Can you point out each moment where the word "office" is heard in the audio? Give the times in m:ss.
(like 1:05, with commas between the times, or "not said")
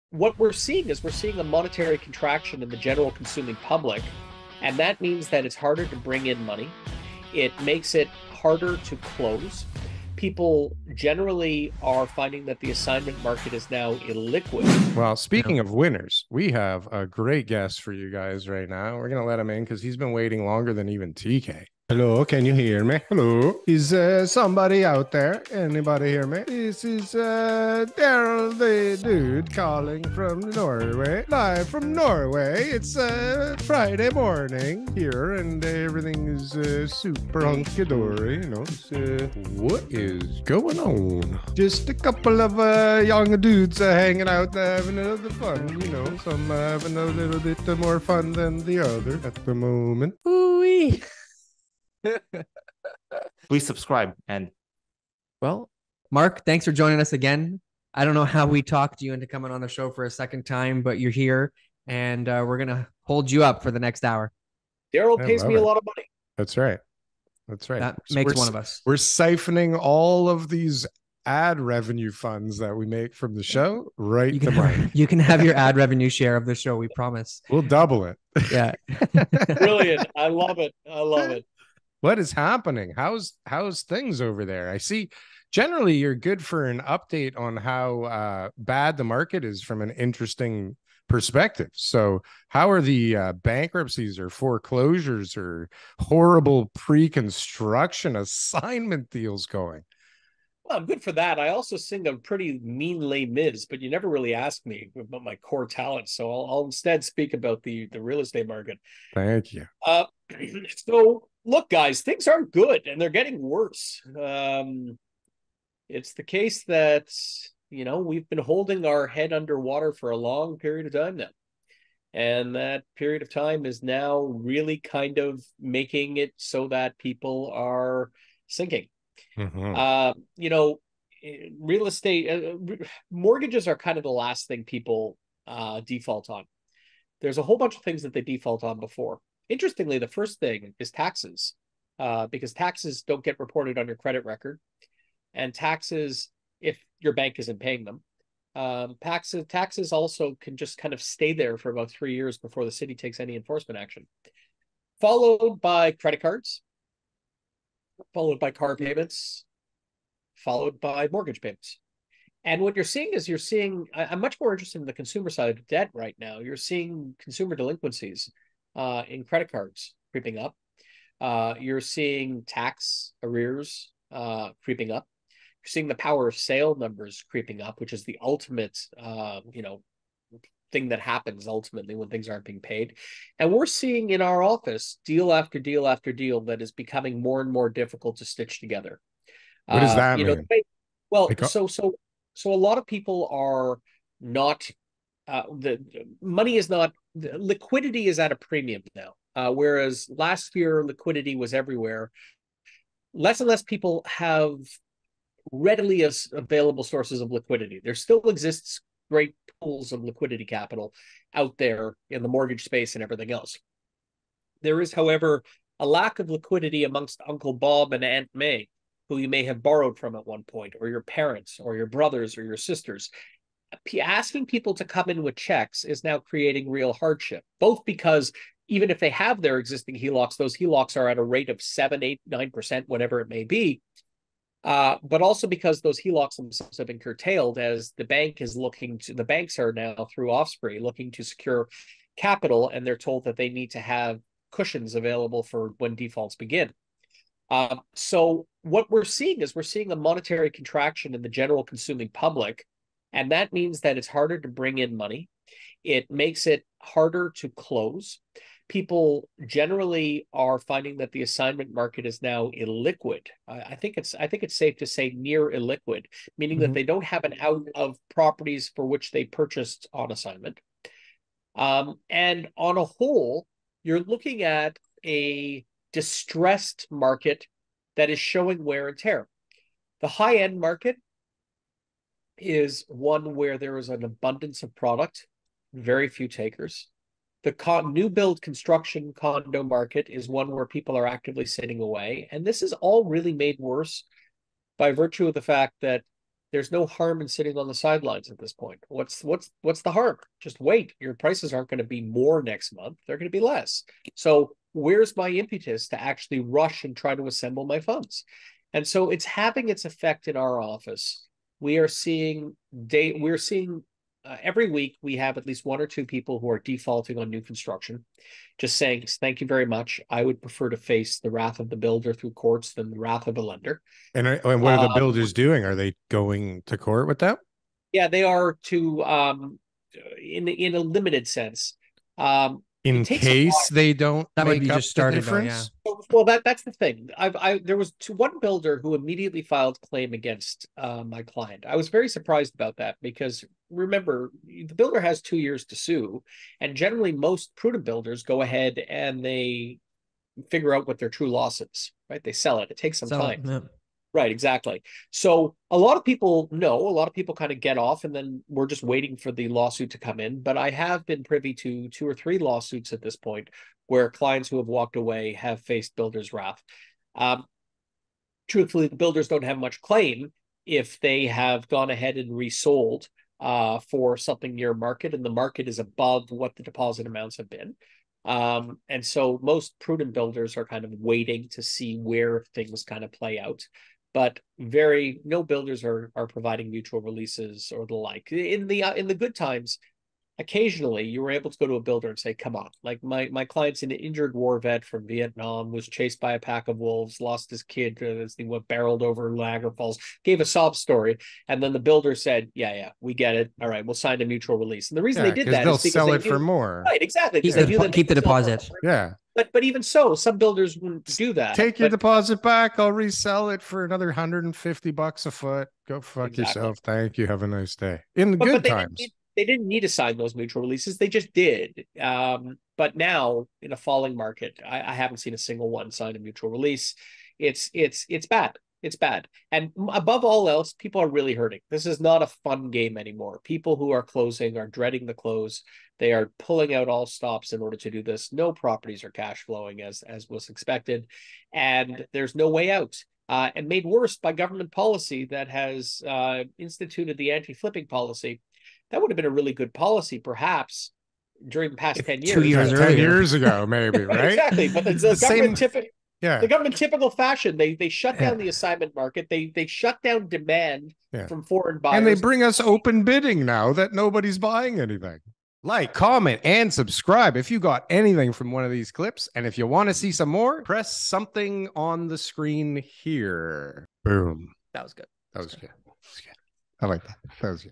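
3:04, 5:10.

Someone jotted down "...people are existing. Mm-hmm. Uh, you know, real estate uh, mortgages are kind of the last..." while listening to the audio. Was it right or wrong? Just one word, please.
wrong.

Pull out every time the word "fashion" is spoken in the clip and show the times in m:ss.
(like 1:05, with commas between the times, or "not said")
7:37.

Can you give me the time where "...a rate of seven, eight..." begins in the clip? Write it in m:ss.
3:51.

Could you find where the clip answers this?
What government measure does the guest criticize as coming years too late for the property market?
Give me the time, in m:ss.
7:27.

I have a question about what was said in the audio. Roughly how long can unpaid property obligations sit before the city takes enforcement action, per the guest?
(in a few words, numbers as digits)
About 3 years.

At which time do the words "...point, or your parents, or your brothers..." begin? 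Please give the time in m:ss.
3:40.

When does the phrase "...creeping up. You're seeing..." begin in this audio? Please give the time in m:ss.
2:54.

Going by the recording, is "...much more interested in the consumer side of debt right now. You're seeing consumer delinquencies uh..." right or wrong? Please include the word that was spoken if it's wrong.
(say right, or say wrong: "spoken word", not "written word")
right.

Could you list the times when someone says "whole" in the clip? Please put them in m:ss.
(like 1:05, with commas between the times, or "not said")
2:17, 4:32.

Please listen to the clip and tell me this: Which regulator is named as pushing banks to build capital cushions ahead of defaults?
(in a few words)
OSFI.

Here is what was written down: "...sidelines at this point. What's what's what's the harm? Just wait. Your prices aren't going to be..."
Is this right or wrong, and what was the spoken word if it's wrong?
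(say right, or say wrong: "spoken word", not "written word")
right.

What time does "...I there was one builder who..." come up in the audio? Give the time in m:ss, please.
5:37.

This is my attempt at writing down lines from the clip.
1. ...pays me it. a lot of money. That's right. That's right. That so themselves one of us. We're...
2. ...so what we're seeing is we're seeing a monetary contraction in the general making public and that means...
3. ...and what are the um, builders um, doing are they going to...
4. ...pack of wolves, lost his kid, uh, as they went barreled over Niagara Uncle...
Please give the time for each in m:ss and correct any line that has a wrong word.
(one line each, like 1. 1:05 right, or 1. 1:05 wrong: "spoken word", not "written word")
1. 1:05 wrong: "makes", not "themselves"
2. 4:07 wrong: "consuming", not "making"
3. 5:24 right
4. 6:36 wrong: "Falls", not "Uncle".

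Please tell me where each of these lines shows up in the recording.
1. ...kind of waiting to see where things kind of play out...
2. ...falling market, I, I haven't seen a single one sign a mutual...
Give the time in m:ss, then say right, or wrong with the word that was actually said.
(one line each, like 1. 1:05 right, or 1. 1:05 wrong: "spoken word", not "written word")
1. 6:20 right
2. 7:03 right.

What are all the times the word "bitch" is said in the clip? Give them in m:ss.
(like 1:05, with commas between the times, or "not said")
not said.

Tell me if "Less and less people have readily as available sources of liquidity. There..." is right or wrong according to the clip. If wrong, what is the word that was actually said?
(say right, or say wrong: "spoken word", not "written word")
right.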